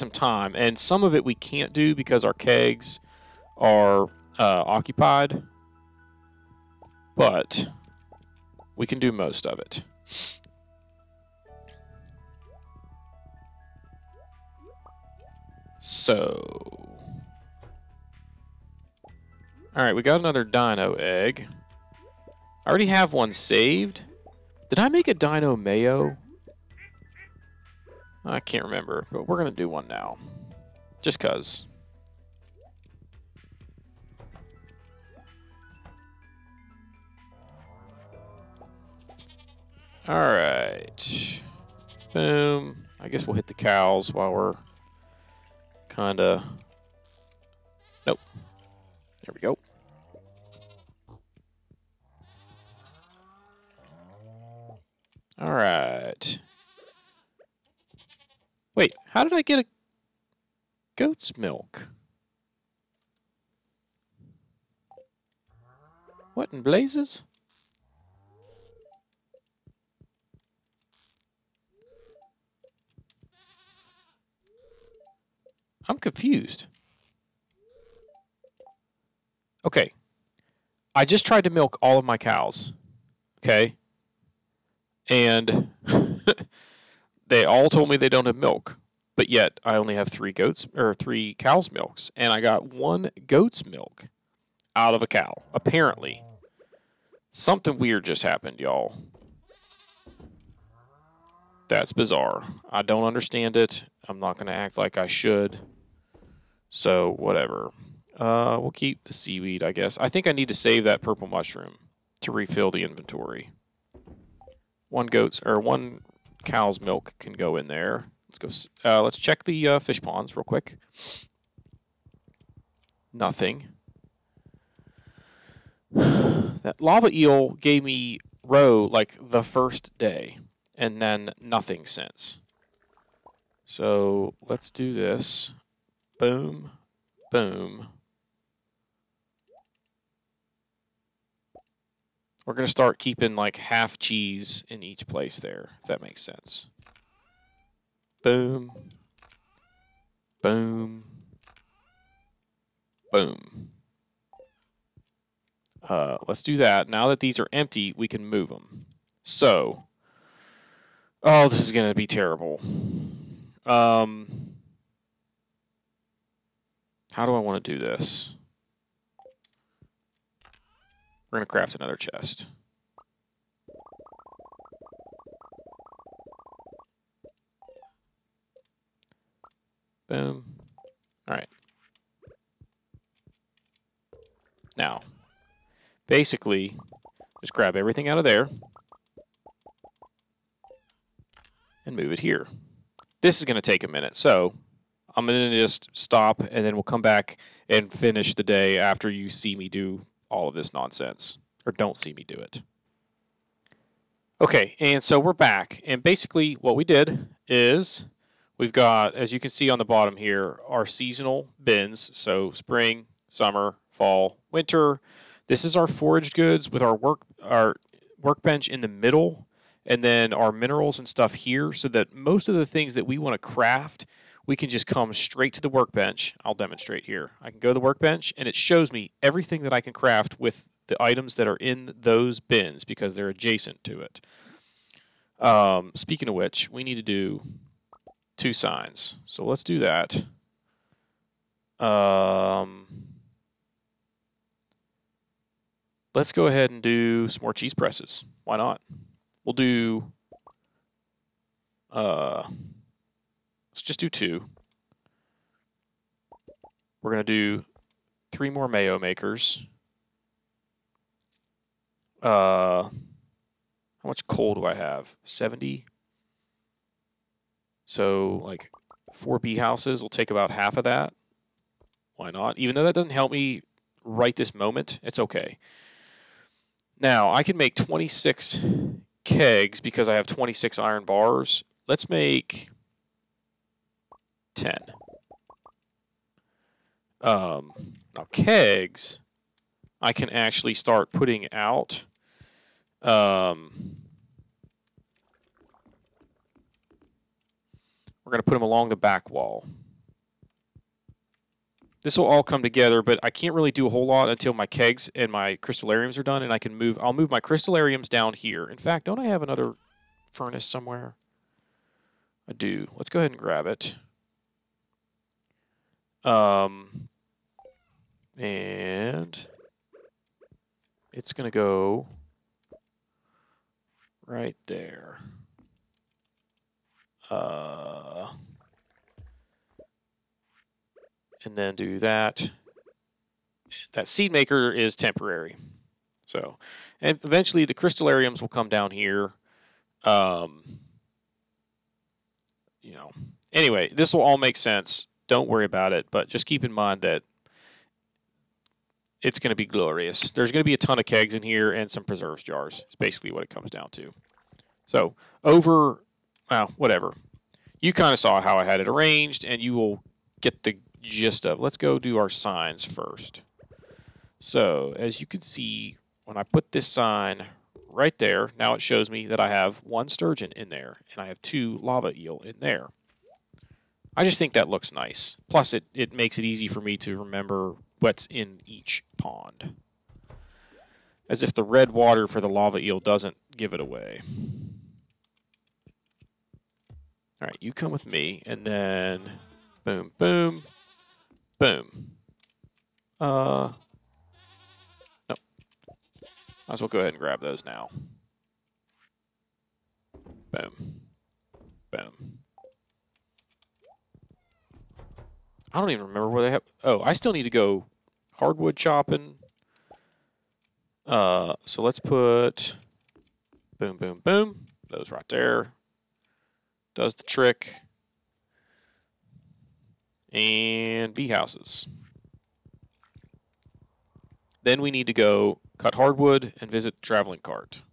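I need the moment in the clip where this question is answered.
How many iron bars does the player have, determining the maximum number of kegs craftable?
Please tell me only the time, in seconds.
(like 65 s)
280 s.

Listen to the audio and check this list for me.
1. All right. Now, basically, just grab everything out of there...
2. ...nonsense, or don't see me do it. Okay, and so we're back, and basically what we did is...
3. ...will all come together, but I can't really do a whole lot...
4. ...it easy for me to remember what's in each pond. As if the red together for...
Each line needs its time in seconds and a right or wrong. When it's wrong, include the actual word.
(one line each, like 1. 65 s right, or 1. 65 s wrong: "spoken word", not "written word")
1. 181 s right
2. 200 s right
3. 302 s right
4. 376 s wrong: "water", not "together".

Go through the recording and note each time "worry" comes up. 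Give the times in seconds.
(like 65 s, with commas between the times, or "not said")
345 s.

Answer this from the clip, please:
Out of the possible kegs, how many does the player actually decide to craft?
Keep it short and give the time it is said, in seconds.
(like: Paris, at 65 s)
10, at 284 s.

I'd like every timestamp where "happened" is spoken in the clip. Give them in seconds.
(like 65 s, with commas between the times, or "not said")
98 s.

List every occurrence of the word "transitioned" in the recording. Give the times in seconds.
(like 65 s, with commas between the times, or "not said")
not said.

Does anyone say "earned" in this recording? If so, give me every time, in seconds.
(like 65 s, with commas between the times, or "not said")
not said.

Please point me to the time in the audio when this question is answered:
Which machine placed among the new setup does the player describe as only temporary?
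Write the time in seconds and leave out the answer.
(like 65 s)
334 s.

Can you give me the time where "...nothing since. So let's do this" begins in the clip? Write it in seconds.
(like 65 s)
131 s.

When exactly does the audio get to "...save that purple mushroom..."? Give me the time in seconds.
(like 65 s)
110 s.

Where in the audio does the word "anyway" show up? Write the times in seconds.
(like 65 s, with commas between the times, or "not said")
343 s.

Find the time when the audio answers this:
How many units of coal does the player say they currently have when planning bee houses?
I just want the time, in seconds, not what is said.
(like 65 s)
265 s.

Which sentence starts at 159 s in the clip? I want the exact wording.
So, oh, this is going to be terrible.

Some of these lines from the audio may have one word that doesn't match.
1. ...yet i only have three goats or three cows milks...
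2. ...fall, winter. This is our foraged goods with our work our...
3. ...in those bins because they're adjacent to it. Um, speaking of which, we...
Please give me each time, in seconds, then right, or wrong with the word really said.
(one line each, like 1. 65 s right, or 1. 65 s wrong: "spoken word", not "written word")
1. 89 s right
2. 213 s right
3. 231 s right.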